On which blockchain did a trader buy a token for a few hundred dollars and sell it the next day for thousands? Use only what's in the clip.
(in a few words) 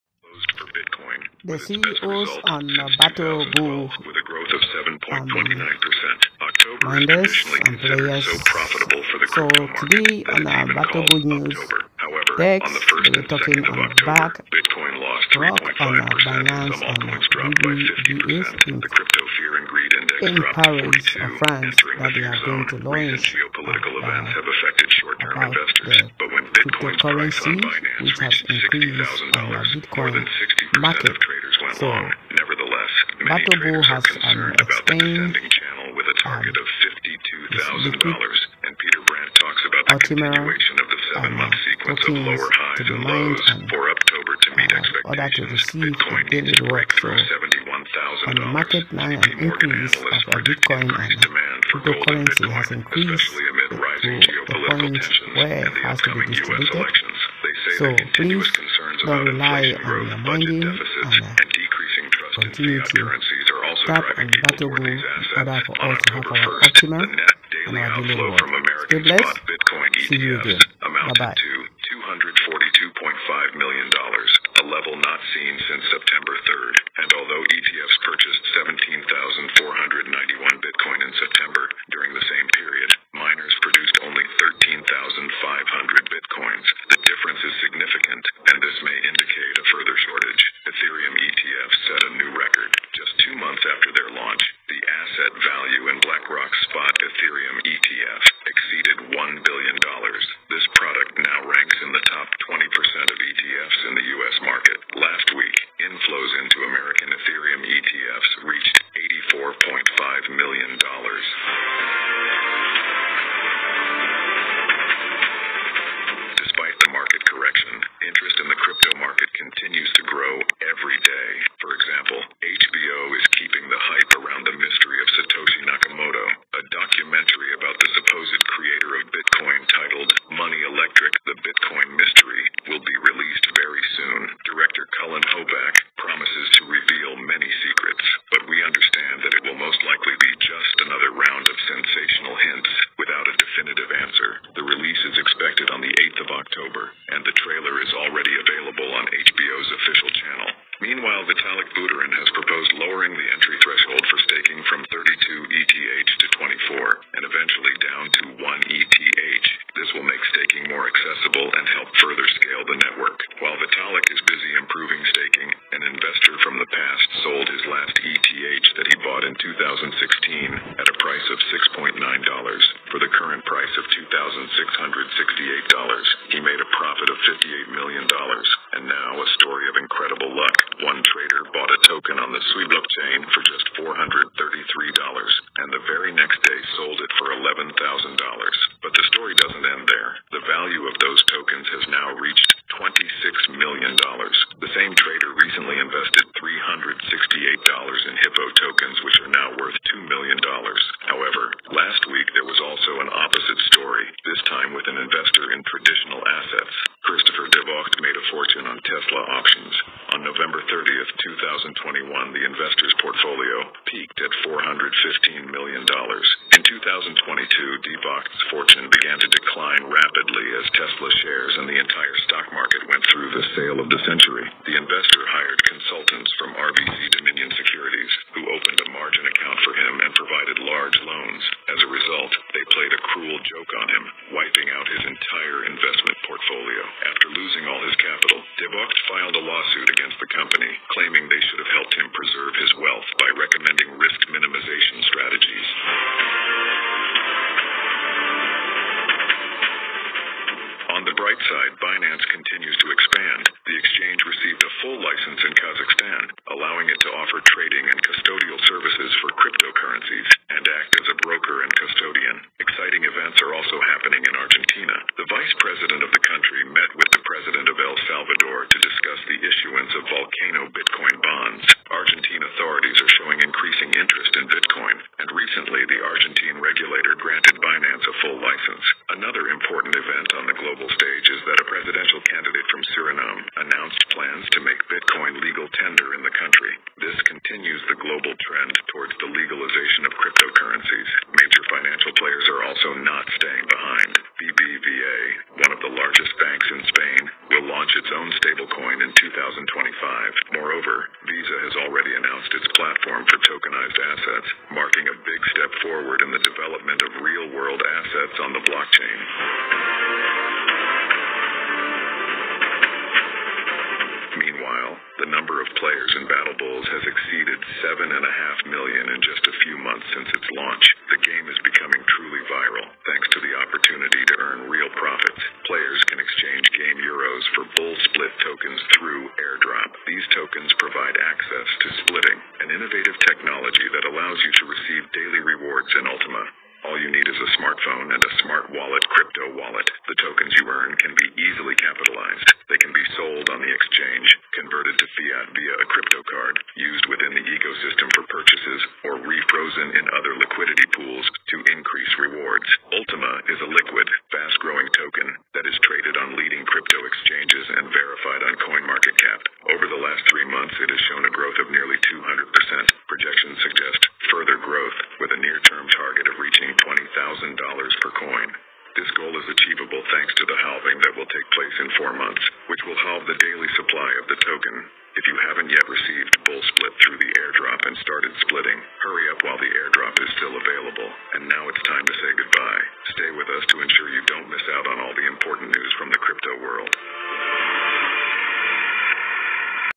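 Sui.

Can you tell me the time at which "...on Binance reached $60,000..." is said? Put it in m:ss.
0:27.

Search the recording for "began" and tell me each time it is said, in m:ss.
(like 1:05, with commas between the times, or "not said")
3:38.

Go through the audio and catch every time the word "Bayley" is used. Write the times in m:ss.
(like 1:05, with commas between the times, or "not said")
not said.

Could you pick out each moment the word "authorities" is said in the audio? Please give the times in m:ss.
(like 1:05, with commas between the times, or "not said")
4:32.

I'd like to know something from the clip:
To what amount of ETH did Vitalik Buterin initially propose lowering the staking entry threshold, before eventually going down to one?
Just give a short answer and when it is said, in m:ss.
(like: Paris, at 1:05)
24, at 2:36.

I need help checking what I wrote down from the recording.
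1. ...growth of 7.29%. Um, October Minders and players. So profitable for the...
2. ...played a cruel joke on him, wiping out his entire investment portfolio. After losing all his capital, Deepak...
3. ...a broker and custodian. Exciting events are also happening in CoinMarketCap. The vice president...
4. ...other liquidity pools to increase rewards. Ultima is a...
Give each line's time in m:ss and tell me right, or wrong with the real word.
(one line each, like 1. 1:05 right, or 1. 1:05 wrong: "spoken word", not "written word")
1. 0:04 right
2. 3:52 right
3. 4:21 wrong: "Argentina", not "CoinMarketCap"
4. 5:50 right.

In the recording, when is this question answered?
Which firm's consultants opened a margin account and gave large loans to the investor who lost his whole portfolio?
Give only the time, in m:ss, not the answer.
3:46.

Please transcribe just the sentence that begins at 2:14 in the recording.
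Director Cullen Hoback promises to reveal many secrets.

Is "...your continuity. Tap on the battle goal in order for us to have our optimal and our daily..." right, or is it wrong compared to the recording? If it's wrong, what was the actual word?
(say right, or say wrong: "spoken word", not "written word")
right.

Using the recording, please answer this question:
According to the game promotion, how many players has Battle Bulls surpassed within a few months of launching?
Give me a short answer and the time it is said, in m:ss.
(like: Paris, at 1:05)
7.5 million, at 5:17.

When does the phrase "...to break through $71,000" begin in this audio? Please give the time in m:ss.
0:46.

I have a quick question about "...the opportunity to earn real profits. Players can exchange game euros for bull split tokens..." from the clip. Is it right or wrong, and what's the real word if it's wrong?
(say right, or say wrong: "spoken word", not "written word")
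right.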